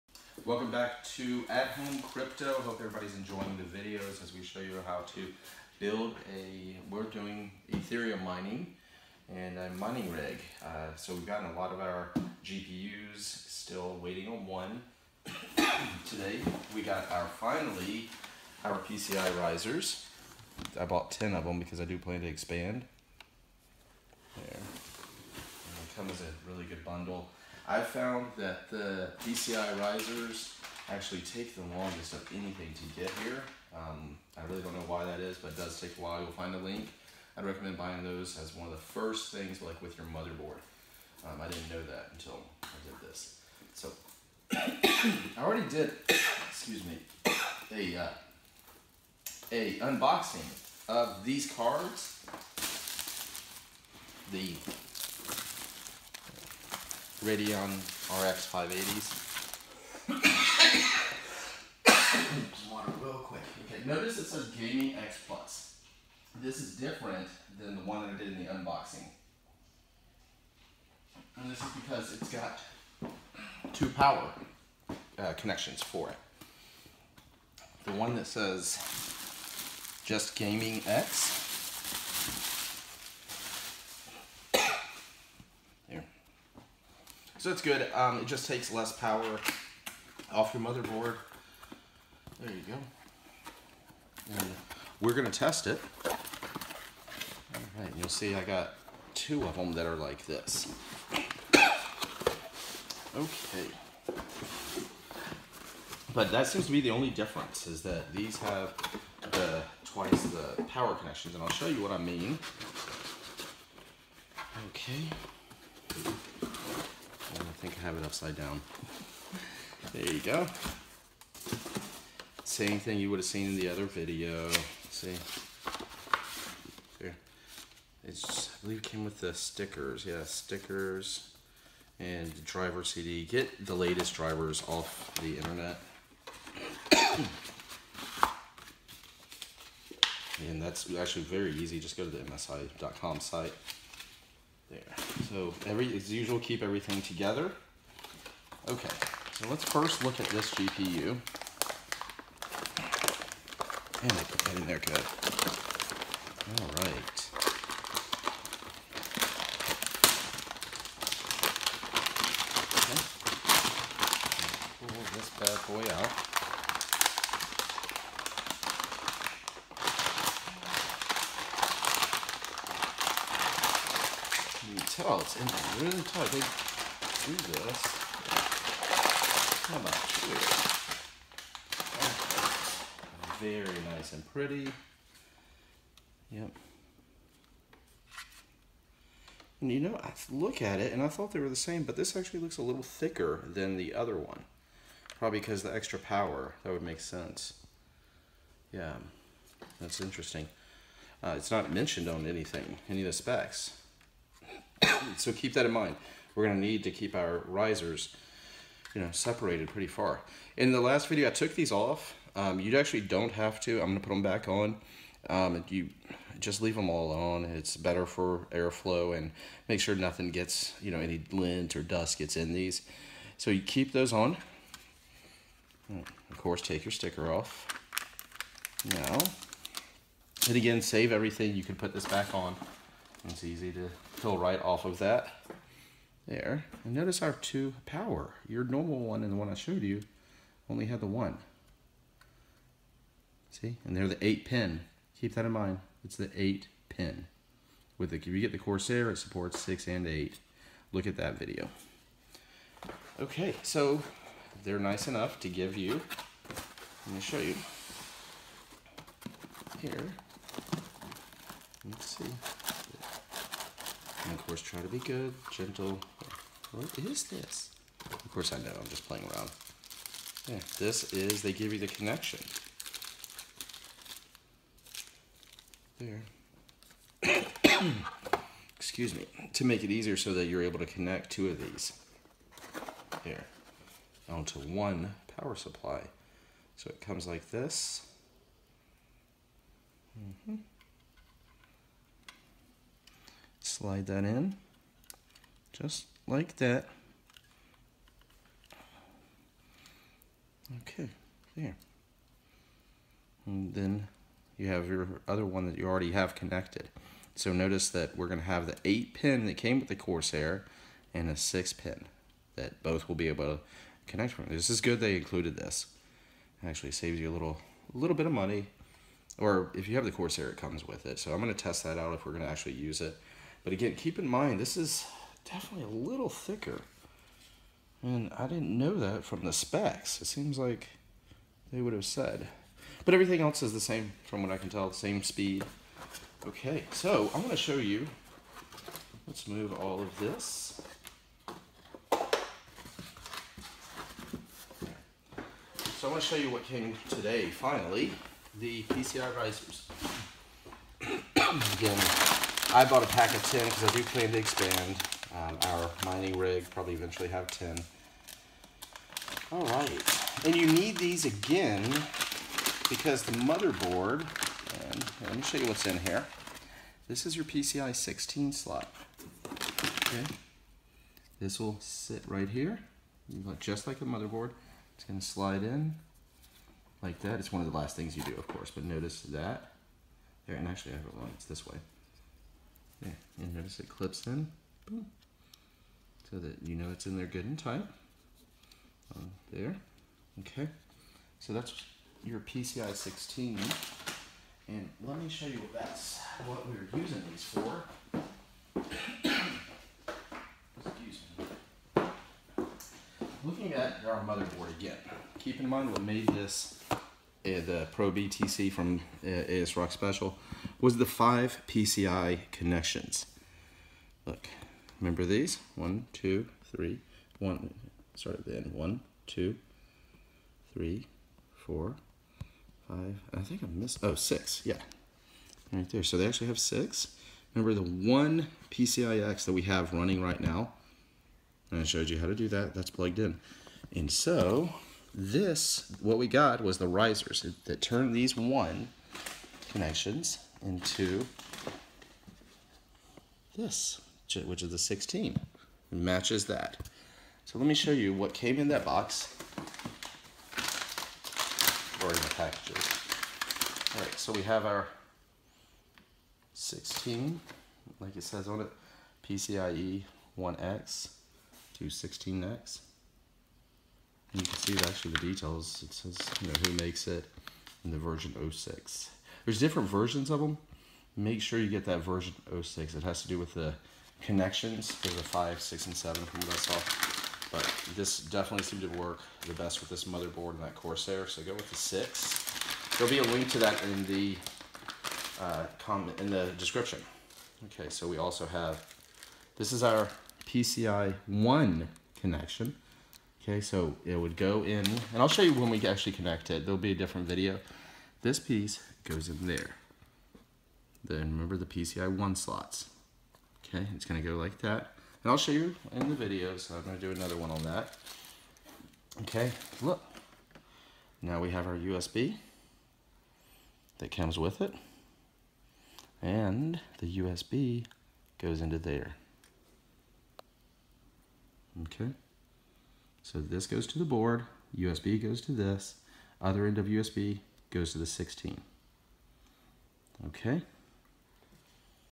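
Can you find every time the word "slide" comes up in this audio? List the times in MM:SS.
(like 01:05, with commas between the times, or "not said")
04:53, 06:15.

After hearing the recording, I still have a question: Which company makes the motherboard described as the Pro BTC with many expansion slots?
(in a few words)
ASRock.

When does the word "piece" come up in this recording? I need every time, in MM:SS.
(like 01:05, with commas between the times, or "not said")
08:18.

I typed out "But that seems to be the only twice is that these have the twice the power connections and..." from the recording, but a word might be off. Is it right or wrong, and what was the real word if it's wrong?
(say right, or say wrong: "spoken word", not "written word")
wrong: "difference", not "twice".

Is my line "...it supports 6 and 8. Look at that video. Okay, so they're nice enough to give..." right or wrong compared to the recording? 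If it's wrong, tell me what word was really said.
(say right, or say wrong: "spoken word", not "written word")
right.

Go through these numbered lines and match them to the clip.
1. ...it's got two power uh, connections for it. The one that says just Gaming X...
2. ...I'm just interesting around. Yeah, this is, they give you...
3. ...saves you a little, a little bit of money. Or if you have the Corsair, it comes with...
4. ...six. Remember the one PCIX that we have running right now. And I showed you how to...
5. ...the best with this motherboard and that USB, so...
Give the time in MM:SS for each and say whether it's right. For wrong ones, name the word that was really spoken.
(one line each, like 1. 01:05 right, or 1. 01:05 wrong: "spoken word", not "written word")
1. 01:12 right
2. 04:28 wrong: "playing", not "interesting"
3. 05:16 right
4. 07:06 right
5. 07:59 wrong: "Corsair", not "USB".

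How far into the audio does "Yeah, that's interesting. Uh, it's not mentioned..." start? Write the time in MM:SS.
03:18.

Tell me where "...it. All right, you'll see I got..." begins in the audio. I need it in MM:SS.
01:35.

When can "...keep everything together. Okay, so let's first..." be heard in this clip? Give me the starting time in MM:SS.
02:26.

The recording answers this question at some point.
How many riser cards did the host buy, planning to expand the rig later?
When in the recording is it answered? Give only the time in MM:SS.
00:20.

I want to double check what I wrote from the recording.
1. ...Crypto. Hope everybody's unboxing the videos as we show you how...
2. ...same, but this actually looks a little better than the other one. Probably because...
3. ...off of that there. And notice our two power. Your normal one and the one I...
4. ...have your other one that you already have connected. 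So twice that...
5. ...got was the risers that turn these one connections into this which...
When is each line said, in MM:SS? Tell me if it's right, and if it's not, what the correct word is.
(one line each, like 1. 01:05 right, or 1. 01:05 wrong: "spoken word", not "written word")
1. 00:02 wrong: "enjoying", not "unboxing"
2. 03:11 wrong: "thicker", not "better"
3. 03:54 right
4. 05:04 wrong: "notice", not "twice"
5. 07:16 right.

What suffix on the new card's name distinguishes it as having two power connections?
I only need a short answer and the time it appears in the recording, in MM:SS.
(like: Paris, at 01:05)
Gaming X Plus, at 01:04.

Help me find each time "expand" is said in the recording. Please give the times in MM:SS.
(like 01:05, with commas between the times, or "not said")
00:22, 05:54.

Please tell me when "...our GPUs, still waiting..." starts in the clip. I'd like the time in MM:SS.
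00:11.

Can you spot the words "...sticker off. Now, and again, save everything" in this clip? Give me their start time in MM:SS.
03:46.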